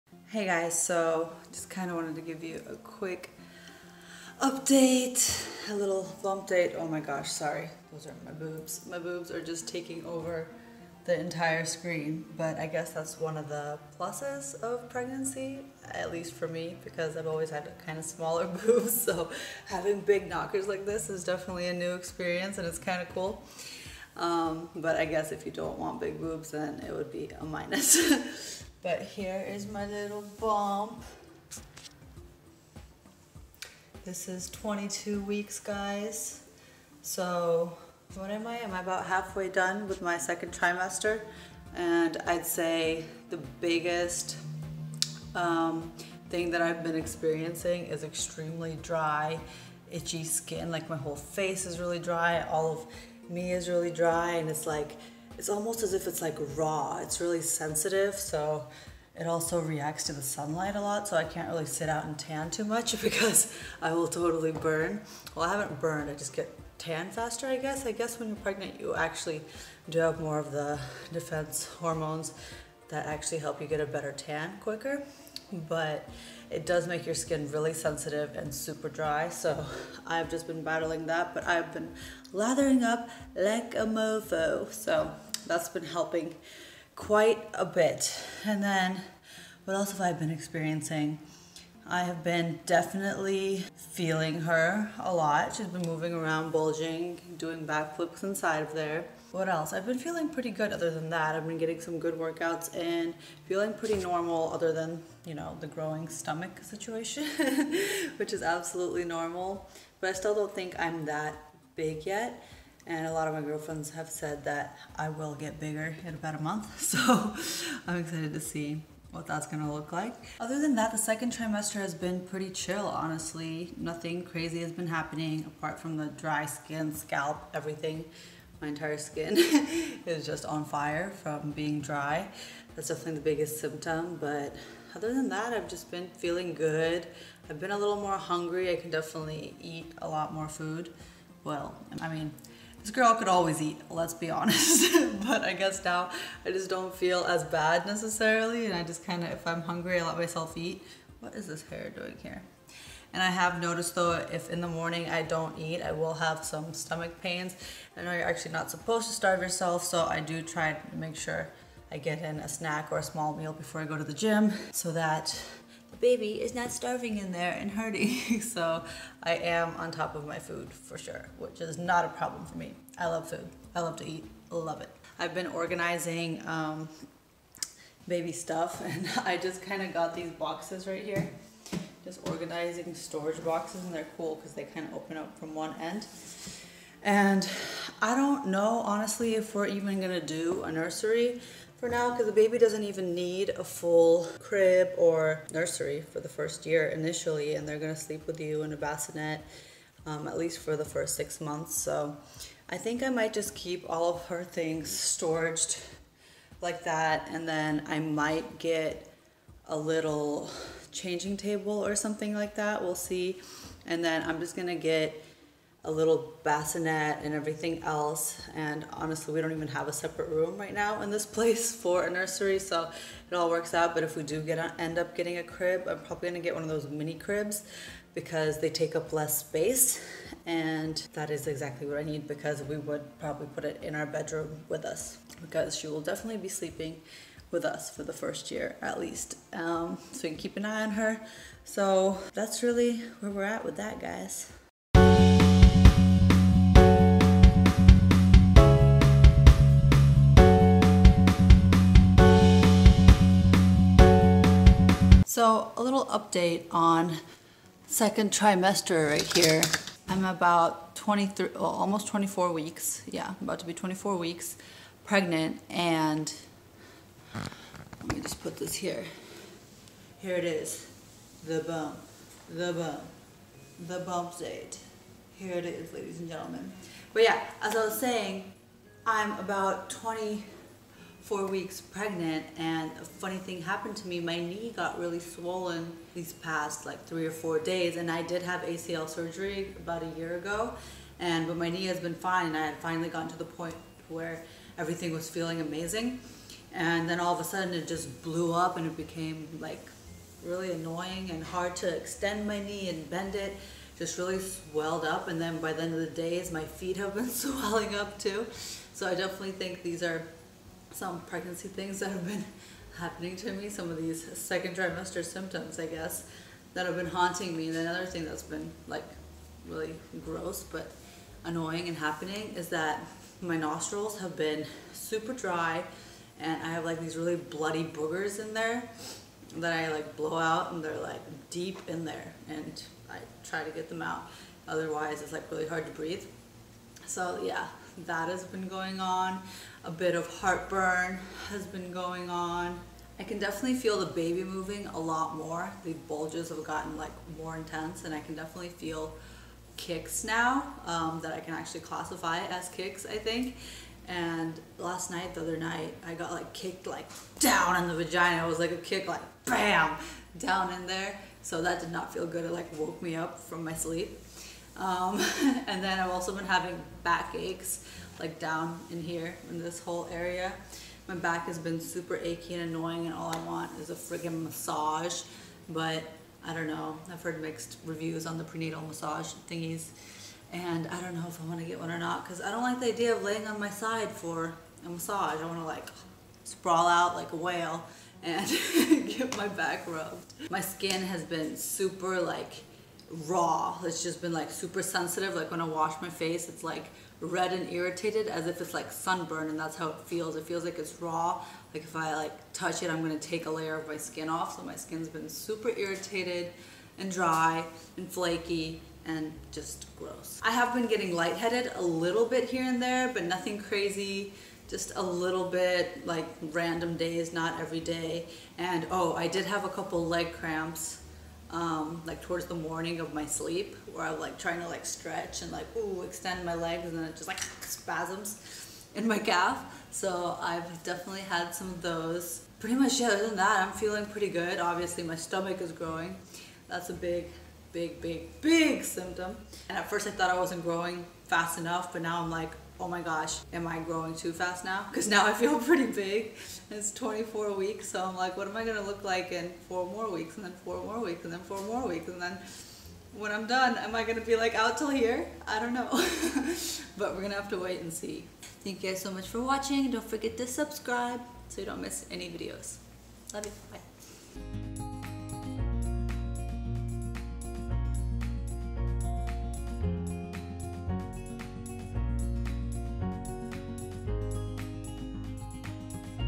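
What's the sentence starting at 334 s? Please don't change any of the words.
Otherwise it's like really hard to breathe.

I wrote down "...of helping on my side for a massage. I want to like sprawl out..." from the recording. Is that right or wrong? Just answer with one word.
wrong.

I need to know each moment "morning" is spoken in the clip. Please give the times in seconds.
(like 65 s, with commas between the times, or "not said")
154 s, 422 s.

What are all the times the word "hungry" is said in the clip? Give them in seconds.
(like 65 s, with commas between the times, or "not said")
138 s, 149 s.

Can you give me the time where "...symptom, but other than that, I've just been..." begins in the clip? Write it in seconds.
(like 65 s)
133 s.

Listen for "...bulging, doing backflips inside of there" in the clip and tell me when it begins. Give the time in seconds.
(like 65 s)
96 s.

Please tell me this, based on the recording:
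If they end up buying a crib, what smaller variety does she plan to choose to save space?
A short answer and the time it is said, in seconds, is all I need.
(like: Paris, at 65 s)
Mini cribs, at 226 s.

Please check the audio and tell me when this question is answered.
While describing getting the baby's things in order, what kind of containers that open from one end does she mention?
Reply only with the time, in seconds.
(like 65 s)
182 s.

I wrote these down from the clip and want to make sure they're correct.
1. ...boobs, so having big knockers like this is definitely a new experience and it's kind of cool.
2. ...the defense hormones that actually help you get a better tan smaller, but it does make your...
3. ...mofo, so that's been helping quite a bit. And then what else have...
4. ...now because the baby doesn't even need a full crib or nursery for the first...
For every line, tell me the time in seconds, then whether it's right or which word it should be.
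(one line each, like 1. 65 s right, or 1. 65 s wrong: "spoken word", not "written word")
1. 18 s right
2. 70 s wrong: "quicker", not "smaller"
3. 83 s right
4. 191 s right.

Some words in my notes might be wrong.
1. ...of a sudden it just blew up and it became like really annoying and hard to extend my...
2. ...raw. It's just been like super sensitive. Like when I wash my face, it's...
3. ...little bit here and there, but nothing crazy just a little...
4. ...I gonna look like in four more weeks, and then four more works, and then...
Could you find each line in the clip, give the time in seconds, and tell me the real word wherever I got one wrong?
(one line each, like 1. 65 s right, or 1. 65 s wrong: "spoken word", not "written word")
1. 297 s right
2. 393 s right
3. 411 s right
4. 448 s wrong: "weeks", not "works".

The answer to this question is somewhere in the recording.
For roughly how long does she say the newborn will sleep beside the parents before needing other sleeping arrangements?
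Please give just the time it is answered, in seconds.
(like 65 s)
201 s.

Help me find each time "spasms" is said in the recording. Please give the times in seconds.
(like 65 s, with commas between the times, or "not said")
427 s.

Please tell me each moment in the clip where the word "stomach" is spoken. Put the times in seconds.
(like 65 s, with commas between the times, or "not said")
106 s, 156 s, 435 s.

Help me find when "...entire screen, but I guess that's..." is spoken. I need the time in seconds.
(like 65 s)
11 s.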